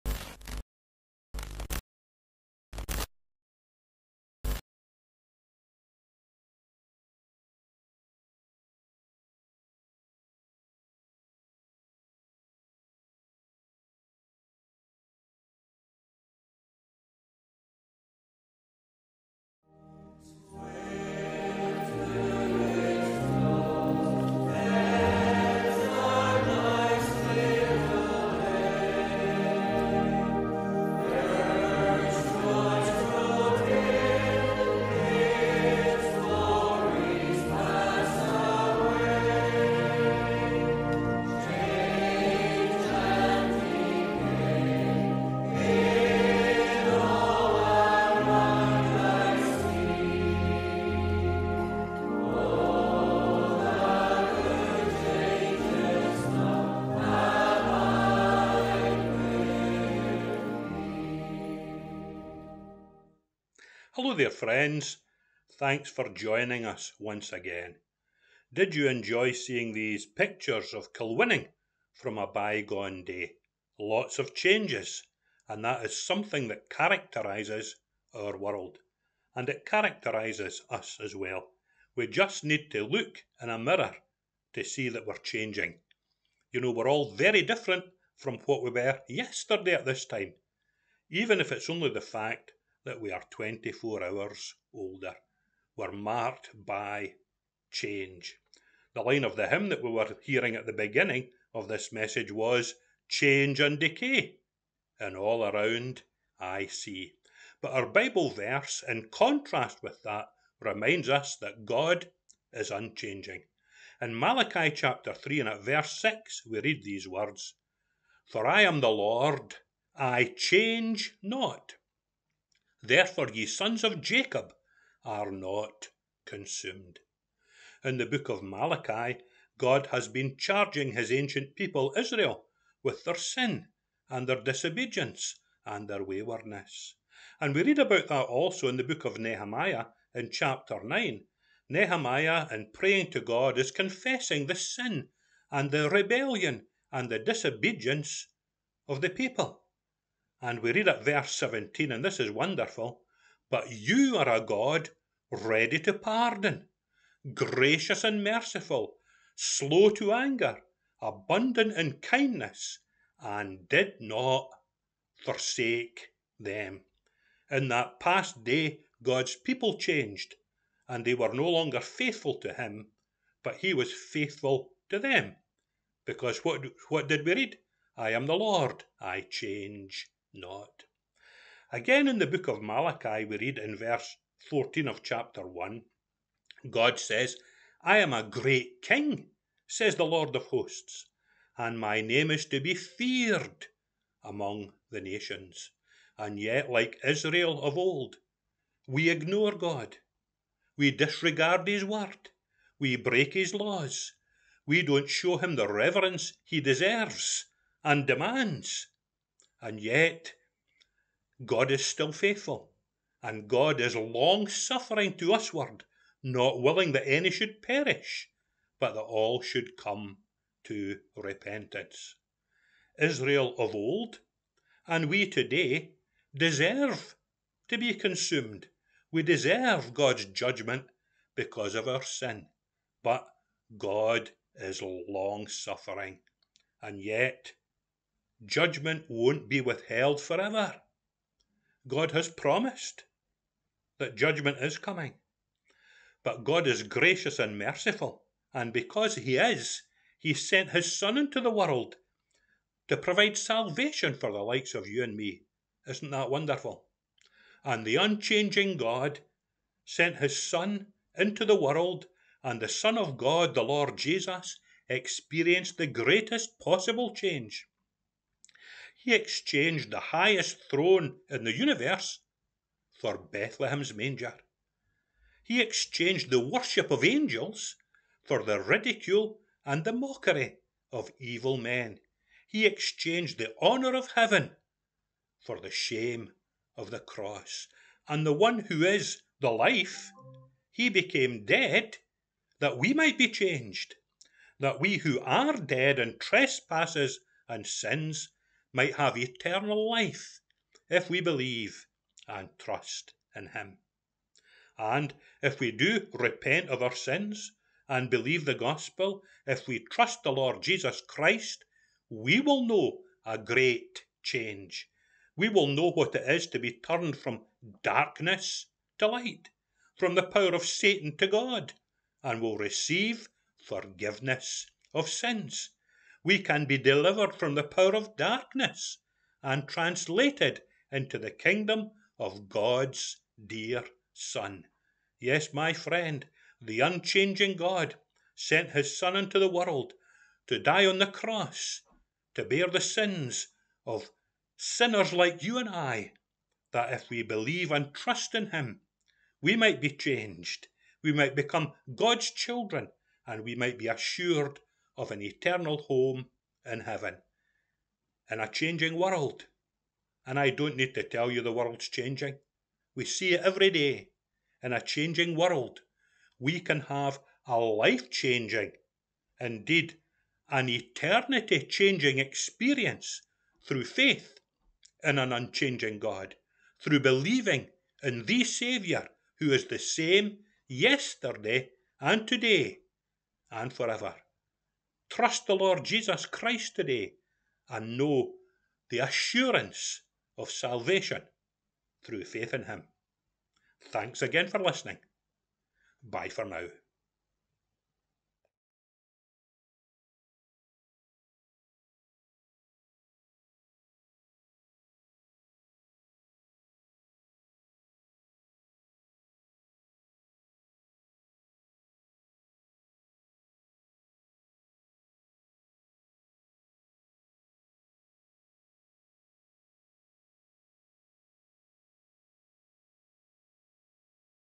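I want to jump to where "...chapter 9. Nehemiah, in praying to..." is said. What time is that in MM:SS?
02:20.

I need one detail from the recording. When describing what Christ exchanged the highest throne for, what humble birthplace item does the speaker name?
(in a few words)
Bethlehem's manger.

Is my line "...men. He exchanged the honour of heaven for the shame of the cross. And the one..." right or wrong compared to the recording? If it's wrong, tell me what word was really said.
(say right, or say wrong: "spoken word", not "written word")
right.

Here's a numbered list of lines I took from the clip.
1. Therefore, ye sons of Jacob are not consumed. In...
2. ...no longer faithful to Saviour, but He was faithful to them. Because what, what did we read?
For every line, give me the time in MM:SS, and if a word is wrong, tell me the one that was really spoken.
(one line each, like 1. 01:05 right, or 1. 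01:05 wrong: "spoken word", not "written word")
1. 02:02 right
2. 02:51 wrong: "Him", not "Saviour".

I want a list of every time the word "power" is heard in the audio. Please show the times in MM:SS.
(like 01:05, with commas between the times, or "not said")
05:20, 05:27.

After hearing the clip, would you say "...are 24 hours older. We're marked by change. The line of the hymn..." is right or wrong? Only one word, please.
right.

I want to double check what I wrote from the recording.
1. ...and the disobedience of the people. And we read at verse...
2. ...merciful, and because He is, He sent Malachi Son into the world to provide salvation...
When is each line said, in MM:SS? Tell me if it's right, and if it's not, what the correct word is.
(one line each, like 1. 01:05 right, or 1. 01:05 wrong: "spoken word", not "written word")
1. 02:26 right
2. 04:07 wrong: "His", not "Malachi".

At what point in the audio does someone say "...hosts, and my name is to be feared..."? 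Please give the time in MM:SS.
03:10.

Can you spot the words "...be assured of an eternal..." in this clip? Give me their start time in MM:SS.
05:53.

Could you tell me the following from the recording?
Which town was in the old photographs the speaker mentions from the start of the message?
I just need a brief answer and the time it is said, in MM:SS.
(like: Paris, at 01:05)
Kilwinning, at 01:10.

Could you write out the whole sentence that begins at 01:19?
And it characterises us as well.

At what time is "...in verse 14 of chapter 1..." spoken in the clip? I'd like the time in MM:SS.
03:03.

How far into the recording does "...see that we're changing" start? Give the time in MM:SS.
01:24.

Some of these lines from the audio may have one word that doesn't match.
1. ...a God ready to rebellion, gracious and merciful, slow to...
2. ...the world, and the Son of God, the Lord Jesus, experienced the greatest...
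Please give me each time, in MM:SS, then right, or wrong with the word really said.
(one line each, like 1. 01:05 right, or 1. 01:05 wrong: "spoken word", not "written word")
1. 02:34 wrong: "pardon", not "rebellion"
2. 04:21 right.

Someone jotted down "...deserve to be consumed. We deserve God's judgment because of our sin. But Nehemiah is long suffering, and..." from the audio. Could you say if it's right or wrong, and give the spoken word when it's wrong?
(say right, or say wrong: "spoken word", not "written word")
wrong: "God", not "Nehemiah".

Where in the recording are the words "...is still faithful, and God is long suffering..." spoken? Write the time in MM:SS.
03:31.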